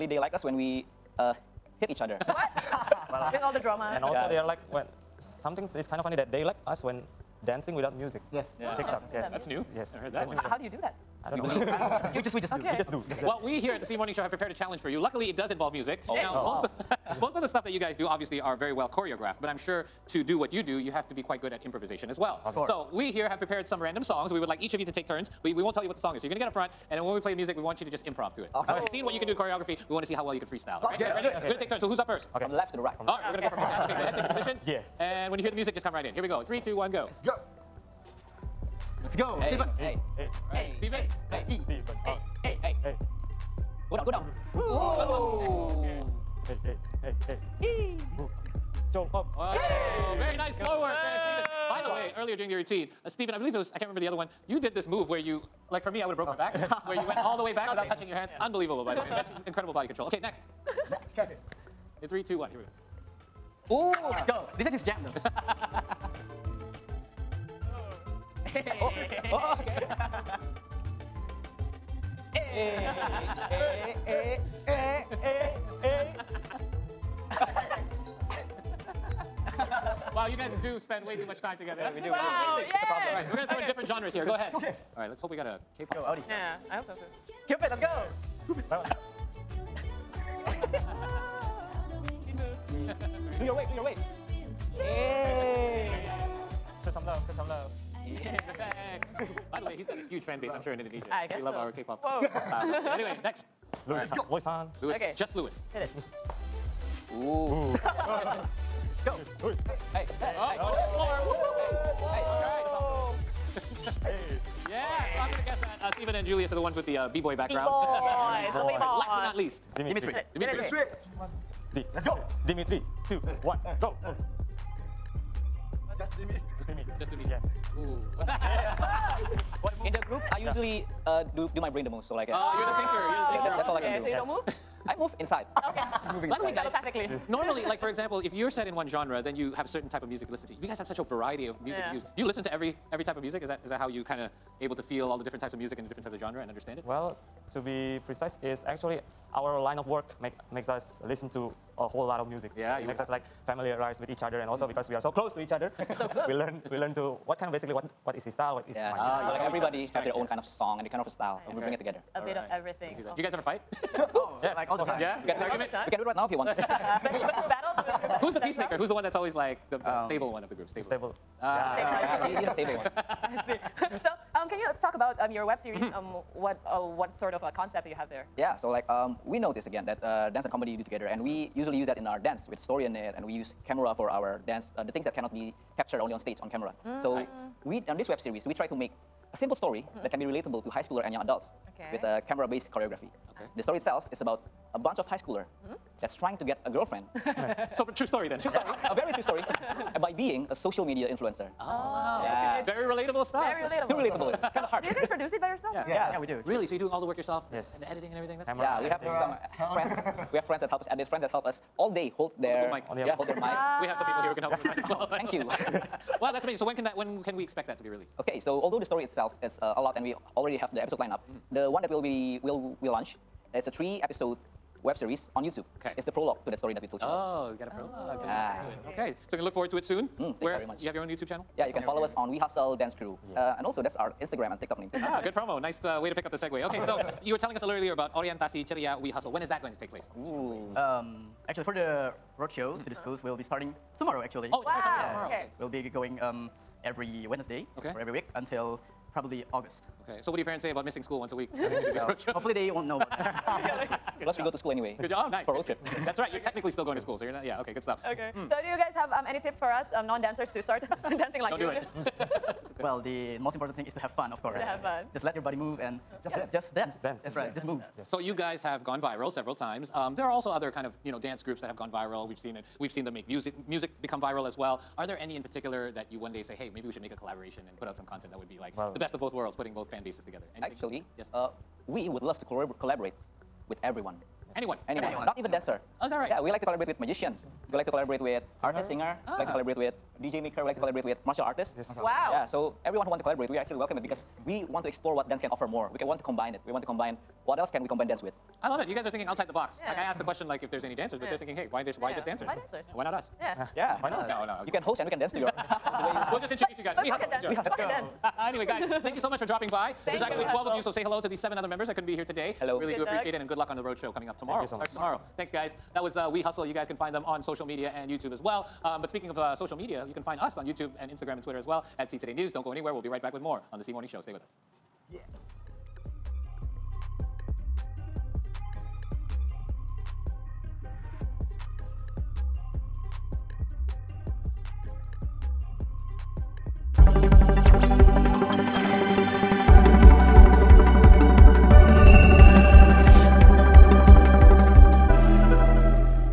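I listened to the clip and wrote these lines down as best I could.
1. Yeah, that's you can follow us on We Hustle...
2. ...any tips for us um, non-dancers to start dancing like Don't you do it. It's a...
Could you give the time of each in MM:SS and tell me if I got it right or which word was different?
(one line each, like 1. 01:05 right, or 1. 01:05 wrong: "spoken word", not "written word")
1. 03:51 right
2. 04:19 right.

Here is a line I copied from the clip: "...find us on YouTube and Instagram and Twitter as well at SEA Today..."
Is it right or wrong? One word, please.
right.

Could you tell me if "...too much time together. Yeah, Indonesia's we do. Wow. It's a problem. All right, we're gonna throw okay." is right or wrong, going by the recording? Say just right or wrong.
wrong.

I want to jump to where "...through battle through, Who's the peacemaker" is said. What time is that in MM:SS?
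02:47.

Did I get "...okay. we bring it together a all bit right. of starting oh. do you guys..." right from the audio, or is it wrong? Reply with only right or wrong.
wrong.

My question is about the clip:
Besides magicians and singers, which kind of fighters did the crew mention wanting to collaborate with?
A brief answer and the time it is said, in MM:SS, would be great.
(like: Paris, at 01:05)
martial artists, at 04:51.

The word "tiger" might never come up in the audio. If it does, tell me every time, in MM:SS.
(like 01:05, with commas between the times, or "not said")
not said.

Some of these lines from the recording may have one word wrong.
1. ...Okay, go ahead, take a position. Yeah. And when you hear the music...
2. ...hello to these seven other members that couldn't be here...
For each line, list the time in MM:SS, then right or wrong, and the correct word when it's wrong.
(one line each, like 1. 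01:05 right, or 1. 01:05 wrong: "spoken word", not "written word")
1. 00:33 right
2. 05:11 right.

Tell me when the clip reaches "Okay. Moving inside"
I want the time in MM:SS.
02:15.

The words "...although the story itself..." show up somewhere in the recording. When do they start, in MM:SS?
03:38.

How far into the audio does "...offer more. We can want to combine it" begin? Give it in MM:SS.
04:55.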